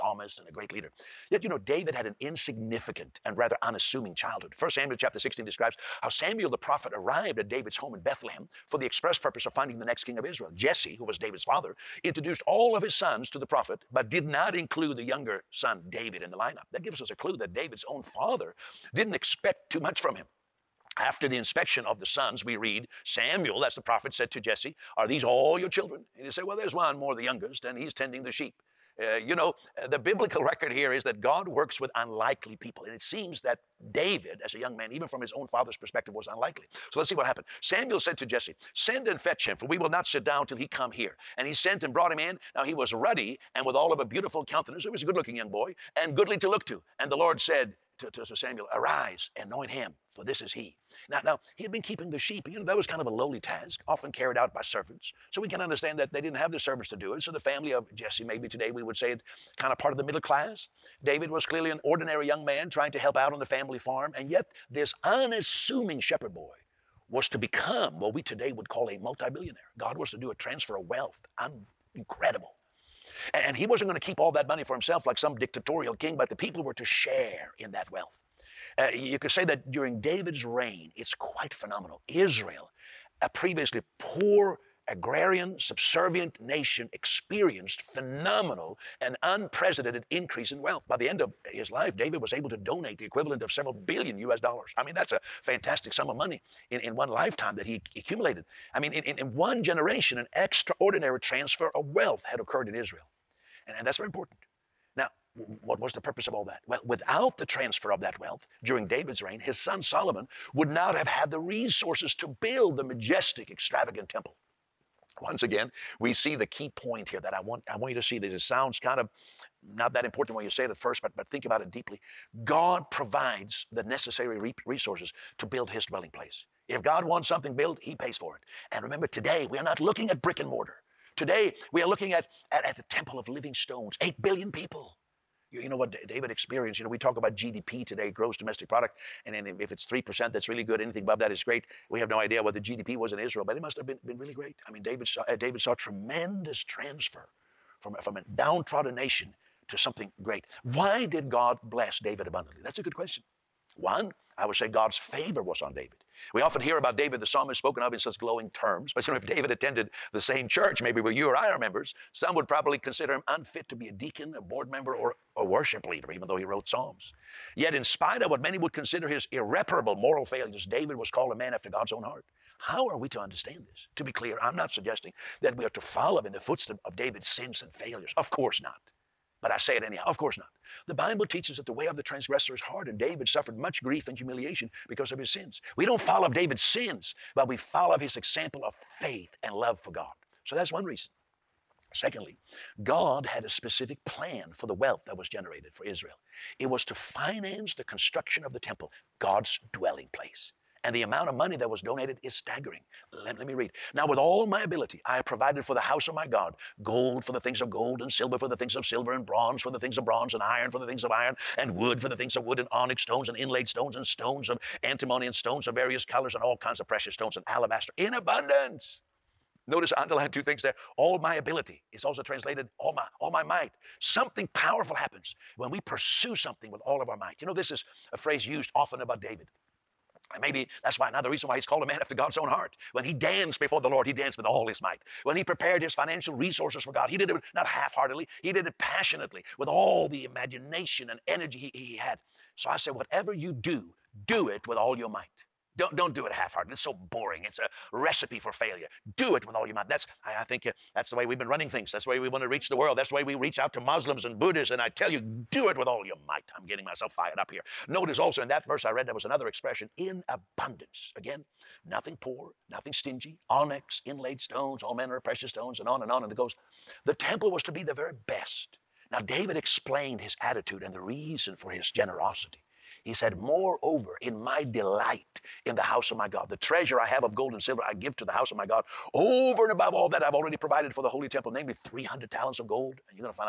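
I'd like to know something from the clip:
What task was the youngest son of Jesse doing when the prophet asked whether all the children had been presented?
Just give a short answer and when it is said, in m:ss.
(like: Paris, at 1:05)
Tending the sheep, at 0:27.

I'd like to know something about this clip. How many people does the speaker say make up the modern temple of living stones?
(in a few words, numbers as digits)
8 billion.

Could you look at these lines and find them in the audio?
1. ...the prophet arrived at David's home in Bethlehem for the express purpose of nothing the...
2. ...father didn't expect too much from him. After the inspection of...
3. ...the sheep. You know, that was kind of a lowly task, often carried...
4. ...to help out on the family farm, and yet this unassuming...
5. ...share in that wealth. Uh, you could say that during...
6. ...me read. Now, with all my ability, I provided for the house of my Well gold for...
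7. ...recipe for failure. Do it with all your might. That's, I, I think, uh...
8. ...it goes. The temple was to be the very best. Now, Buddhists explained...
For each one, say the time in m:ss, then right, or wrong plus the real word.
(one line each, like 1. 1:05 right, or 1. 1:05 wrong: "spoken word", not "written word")
1. 0:06 wrong: "finding", not "nothing"
2. 0:18 right
3. 0:52 right
4. 1:02 right
5. 1:16 right
6. 3:23 wrong: "God", not "Well"
7. 4:07 right
8. 4:26 wrong: "David", not "Buddhists".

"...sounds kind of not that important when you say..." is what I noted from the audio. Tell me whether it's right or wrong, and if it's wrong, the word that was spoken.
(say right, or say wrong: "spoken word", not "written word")
right.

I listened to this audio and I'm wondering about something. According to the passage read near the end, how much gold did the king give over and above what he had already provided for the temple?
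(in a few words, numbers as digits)
300 talents.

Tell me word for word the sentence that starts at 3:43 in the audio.
Something powerful happens when we pursue something with all of our might.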